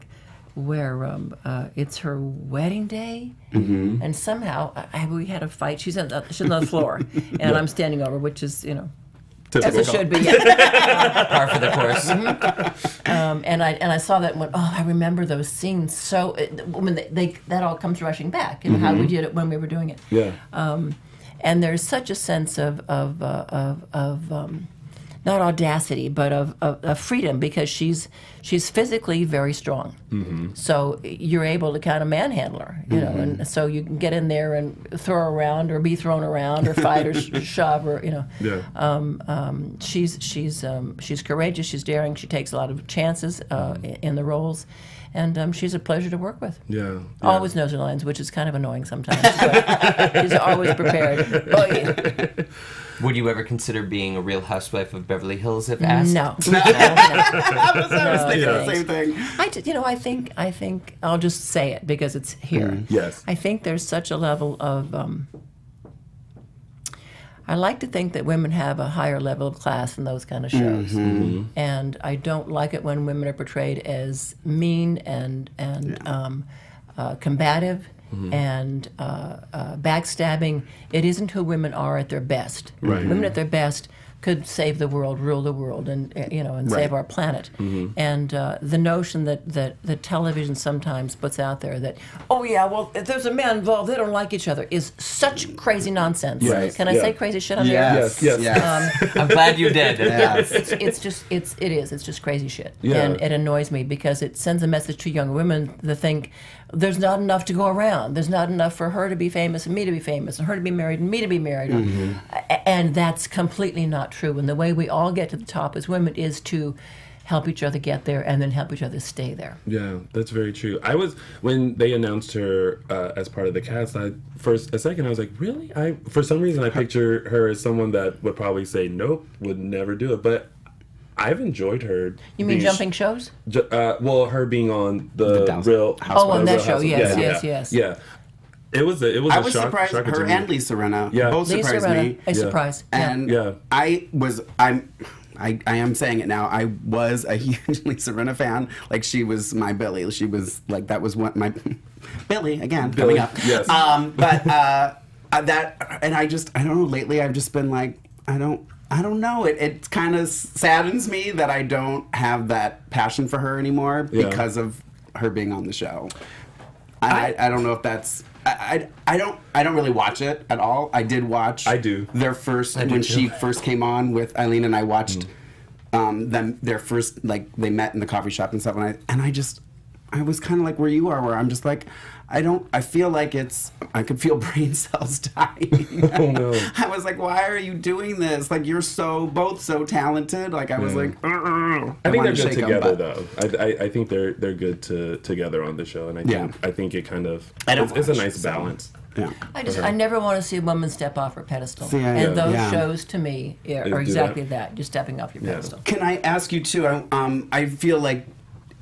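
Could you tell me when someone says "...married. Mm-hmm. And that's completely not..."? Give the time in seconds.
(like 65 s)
111 s.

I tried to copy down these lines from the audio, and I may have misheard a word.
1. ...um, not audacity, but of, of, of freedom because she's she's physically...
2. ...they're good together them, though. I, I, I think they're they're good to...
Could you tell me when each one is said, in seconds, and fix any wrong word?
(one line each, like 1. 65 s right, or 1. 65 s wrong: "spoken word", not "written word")
1. 24 s right
2. 192 s right.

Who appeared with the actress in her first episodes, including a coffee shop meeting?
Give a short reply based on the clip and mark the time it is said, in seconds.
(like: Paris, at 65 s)
Eileen, at 174 s.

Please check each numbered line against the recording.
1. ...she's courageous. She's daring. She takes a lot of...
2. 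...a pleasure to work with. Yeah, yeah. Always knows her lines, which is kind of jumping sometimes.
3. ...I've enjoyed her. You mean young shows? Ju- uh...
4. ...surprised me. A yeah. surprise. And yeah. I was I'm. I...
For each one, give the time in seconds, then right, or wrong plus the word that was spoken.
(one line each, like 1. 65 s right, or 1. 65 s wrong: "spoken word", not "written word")
1. 40 s right
2. 45 s wrong: "annoying", not "jumping"
3. 131 s wrong: "jumping", not "young"
4. 141 s right.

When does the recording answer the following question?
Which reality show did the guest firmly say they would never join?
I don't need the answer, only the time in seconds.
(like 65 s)
54 s.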